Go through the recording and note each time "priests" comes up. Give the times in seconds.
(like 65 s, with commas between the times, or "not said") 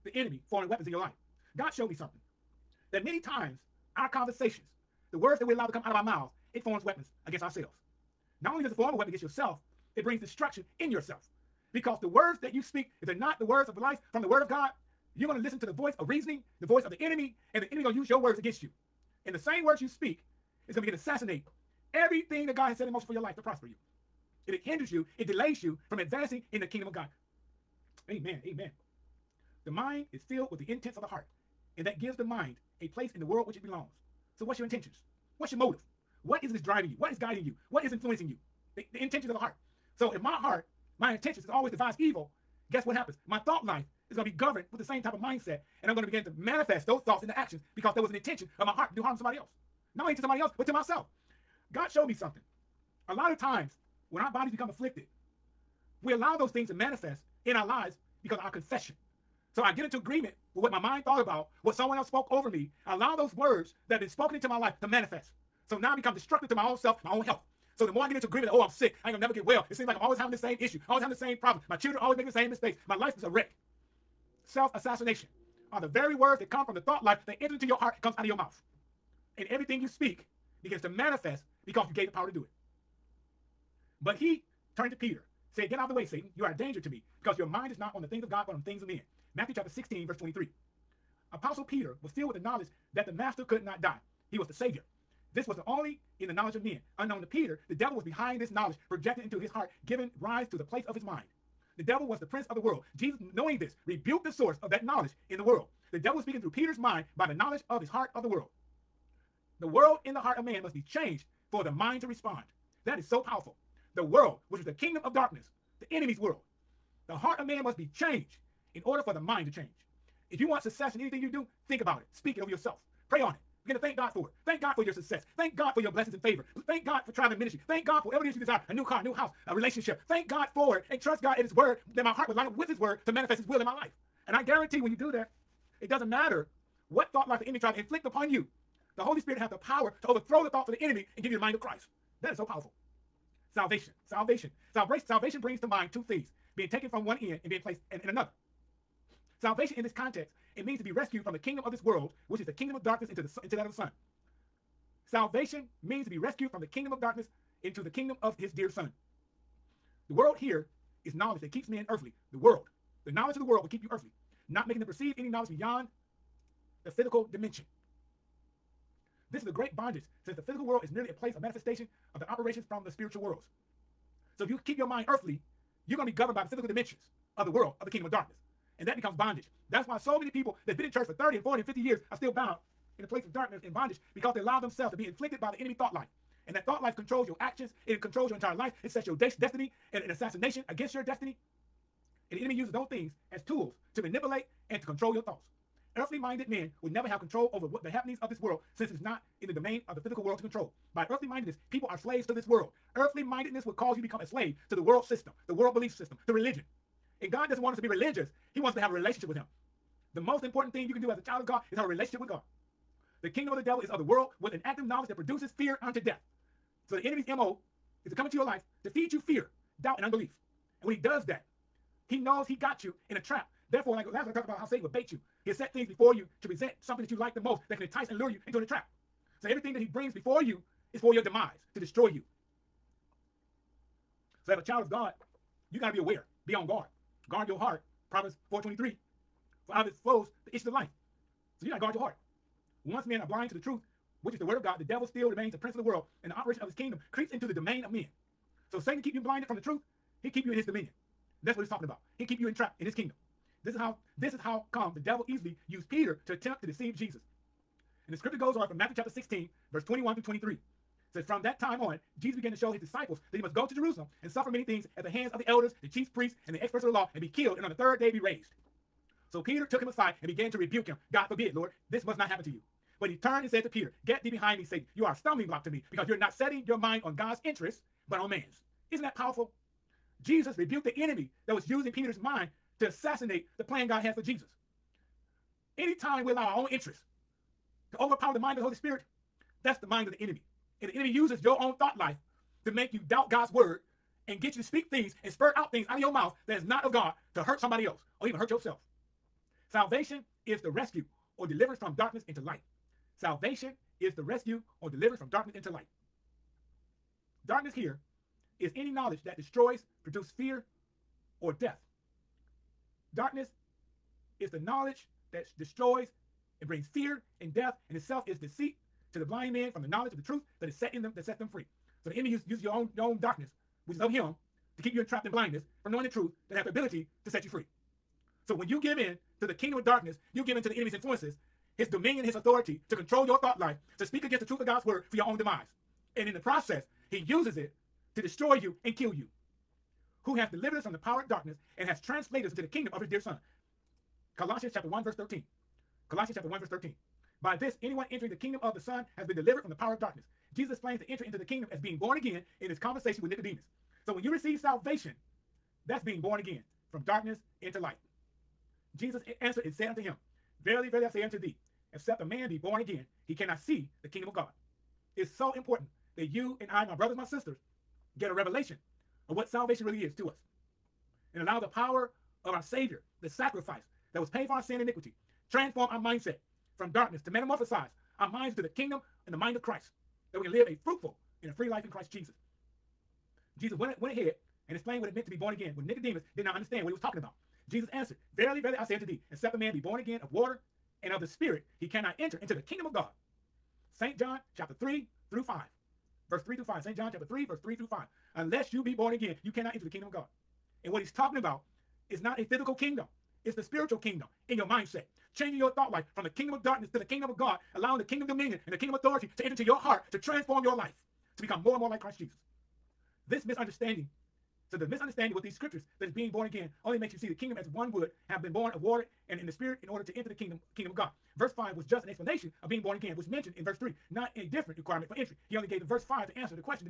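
266 s.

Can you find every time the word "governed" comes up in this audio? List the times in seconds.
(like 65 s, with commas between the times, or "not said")
44 s, 176 s.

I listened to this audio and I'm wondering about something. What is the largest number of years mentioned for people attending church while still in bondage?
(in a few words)
50.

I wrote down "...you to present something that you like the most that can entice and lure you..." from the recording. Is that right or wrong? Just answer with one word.
right.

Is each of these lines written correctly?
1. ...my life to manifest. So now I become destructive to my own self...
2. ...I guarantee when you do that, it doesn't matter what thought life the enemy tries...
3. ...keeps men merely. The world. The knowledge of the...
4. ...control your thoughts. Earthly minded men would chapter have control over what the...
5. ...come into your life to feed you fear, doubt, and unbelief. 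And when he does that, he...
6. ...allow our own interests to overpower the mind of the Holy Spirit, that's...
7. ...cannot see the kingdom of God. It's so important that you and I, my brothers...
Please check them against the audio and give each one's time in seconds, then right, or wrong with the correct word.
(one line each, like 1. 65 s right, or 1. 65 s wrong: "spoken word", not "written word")
1. 64 s right
2. 134 s right
3. 161 s wrong: "earthly", not "merely"
4. 194 s wrong: "never", not "chapter"
5. 218 s right
6. 286 s right
7. 363 s right.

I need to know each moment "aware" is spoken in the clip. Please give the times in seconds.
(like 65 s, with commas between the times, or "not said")
235 s.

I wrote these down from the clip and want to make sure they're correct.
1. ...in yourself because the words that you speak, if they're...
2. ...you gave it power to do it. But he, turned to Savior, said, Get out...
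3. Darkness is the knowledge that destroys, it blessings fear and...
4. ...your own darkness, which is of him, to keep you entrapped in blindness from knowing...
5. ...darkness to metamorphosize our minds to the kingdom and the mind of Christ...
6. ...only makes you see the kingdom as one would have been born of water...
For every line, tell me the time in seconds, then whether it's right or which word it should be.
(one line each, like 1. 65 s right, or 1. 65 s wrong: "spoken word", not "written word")
1. 10 s right
2. 81 s wrong: "Peter", not "Savior"
3. 313 s wrong: "brings", not "blessings"
4. 322 s right
5. 376 s right
6. 416 s right.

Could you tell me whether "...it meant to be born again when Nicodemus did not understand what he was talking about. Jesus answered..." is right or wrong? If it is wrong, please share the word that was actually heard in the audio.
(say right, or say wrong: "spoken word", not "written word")
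right.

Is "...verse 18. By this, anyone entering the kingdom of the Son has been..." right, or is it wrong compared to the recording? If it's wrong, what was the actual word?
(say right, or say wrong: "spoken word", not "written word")
wrong: "13", not "18".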